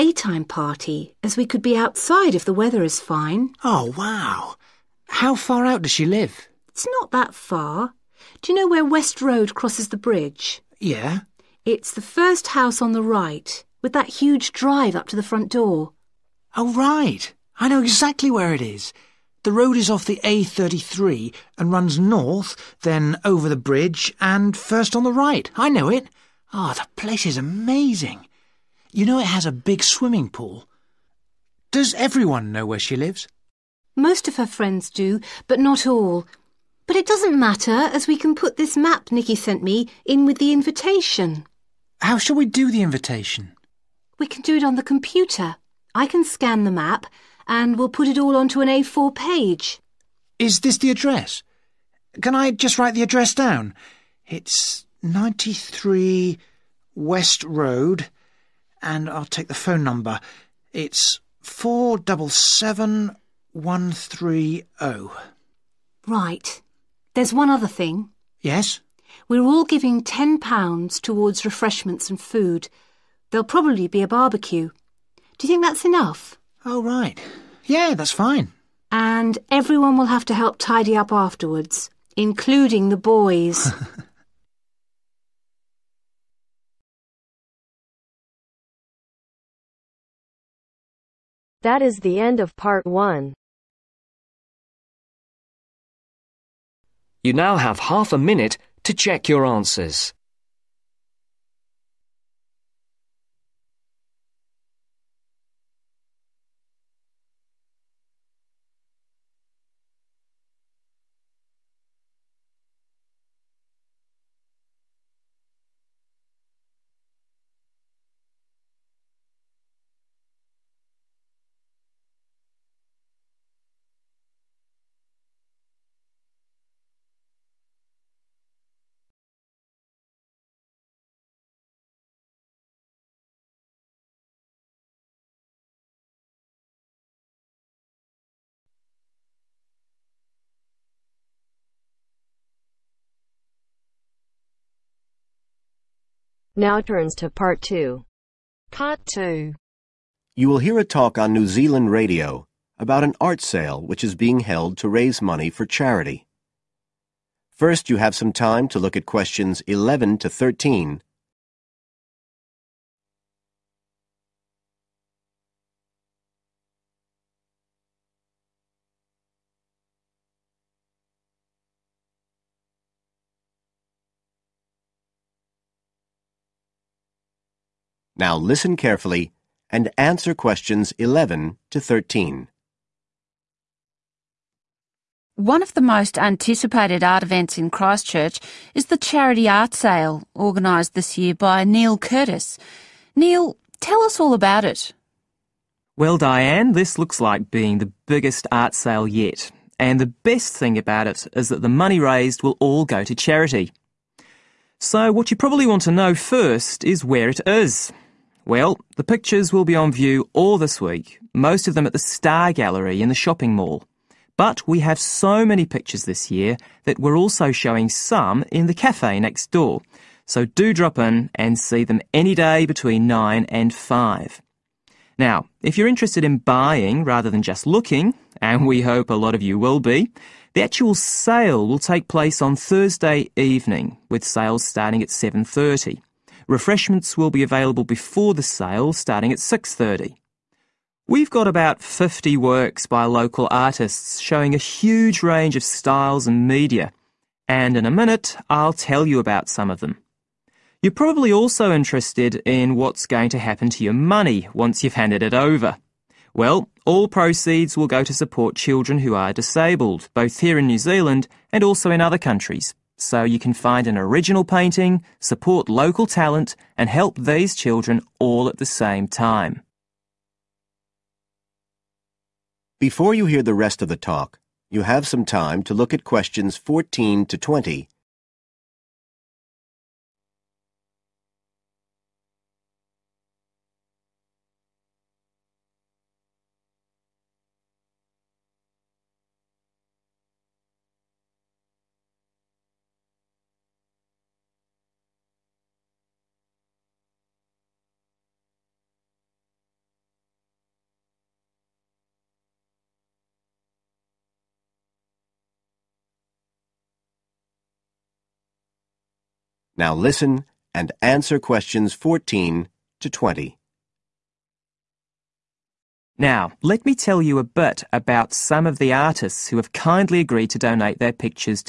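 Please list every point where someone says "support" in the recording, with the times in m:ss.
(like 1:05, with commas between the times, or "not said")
4:18, 4:25.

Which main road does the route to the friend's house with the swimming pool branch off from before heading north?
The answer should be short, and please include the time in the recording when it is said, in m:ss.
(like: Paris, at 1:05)
A33, at 0:20.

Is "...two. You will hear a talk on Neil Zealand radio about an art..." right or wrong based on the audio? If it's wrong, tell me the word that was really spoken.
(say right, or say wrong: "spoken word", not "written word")
wrong: "New", not "Neil".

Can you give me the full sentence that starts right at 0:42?
How shall we do the invitation?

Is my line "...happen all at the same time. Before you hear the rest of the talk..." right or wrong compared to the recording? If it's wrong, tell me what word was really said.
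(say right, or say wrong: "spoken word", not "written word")
wrong: "children", not "happen".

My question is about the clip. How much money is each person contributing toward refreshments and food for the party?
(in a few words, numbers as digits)
£10.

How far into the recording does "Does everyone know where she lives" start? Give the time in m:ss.
0:31.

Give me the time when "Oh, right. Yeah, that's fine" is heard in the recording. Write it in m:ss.
1:16.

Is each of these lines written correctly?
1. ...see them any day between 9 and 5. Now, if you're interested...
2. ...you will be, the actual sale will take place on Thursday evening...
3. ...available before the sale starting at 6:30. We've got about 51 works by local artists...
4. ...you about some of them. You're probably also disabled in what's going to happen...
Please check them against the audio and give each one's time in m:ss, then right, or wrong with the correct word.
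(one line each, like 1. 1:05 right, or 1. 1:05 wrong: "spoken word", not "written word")
1. 3:41 right
2. 3:49 right
3. 3:57 wrong: "50", not "51"
4. 4:09 wrong: "interested", not "disabled".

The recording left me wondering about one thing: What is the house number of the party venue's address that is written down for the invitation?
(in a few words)
93.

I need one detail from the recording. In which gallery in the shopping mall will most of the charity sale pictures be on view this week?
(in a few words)
Star Gallery.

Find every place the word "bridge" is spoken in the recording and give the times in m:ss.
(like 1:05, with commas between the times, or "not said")
0:09, 0:23.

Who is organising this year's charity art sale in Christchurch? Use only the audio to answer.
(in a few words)
Neil Curtis.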